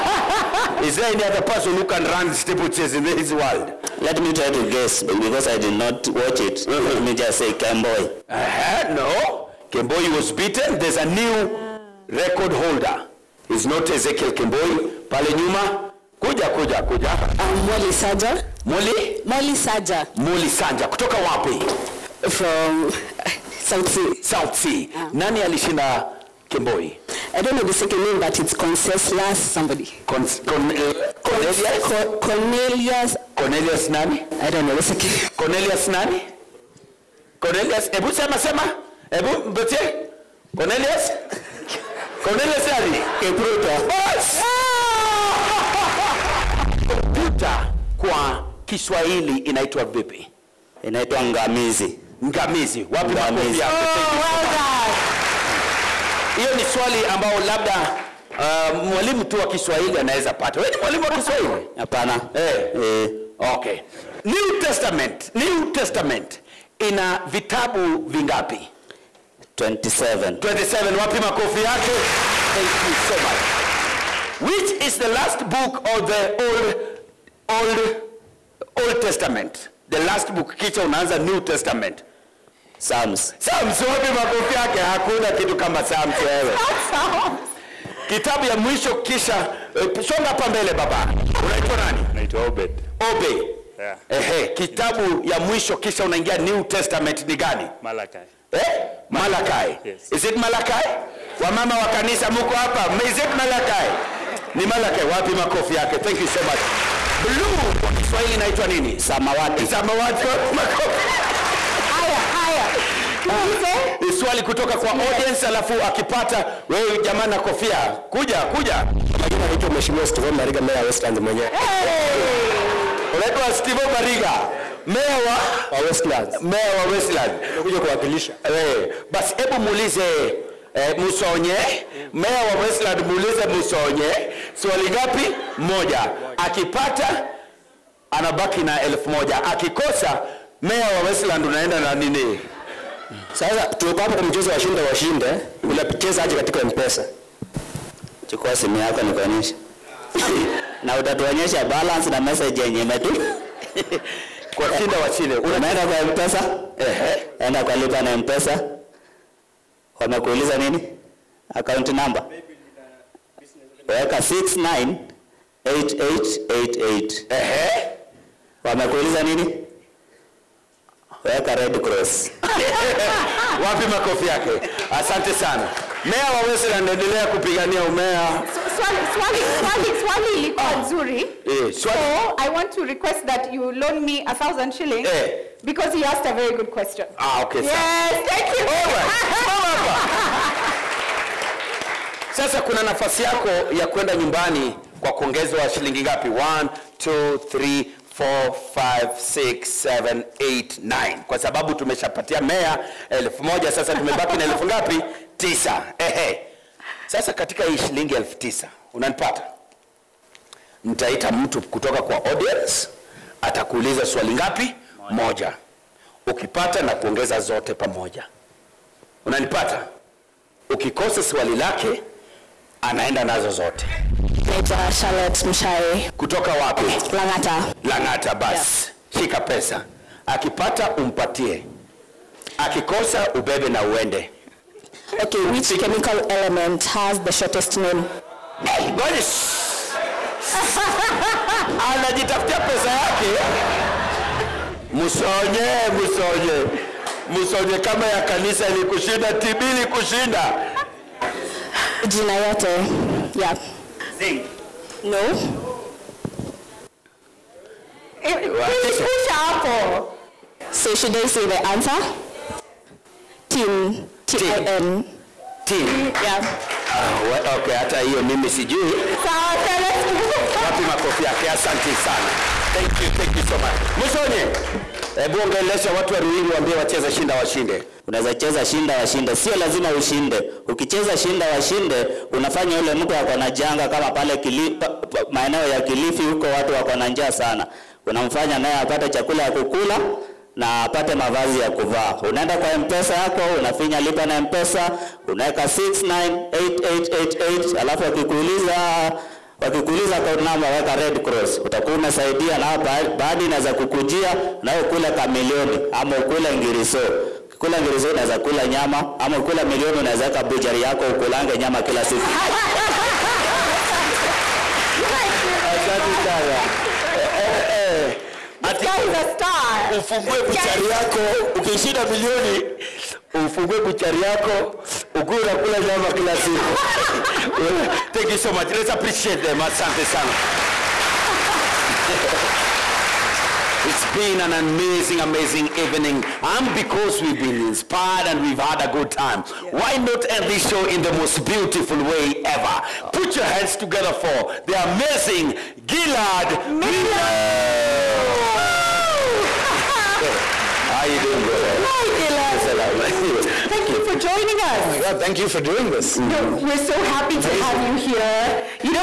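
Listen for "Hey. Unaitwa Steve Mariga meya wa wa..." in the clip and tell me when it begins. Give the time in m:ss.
2:01.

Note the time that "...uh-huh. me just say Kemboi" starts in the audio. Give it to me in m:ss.
0:06.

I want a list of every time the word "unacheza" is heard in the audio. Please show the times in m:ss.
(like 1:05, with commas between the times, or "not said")
2:25.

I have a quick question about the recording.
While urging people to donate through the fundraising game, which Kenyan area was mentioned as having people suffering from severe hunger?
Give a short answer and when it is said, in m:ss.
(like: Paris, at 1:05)
Kilifi, at 4:45.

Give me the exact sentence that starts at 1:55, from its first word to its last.
audience alafu akipata wewe jamaa na kofia.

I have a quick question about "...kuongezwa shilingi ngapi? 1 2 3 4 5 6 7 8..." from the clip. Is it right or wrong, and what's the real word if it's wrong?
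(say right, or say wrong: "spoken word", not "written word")
right.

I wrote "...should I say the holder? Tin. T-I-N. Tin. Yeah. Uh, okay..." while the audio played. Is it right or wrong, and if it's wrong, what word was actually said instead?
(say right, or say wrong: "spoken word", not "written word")
wrong: "answer", not "holder".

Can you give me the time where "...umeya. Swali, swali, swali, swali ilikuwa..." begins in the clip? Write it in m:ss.
2:57.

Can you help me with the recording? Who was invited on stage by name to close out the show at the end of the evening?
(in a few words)
Gilad Millo.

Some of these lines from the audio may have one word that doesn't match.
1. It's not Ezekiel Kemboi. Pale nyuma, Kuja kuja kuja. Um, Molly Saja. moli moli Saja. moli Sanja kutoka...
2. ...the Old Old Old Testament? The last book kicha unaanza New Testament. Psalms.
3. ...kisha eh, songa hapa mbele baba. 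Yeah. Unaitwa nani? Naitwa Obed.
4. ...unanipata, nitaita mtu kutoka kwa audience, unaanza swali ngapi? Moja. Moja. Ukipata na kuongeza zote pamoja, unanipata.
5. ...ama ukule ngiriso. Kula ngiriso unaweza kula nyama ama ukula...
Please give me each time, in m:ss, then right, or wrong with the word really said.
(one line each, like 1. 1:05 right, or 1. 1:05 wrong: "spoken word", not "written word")
1. 0:13 right
2. 1:16 right
3. 1:28 right
4. 3:28 wrong: "atakuuliza", not "unaanza"
5. 5:05 right.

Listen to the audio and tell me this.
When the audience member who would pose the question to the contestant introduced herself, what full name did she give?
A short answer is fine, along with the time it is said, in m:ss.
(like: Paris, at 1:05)
Charlotte Mshai, at 3:44.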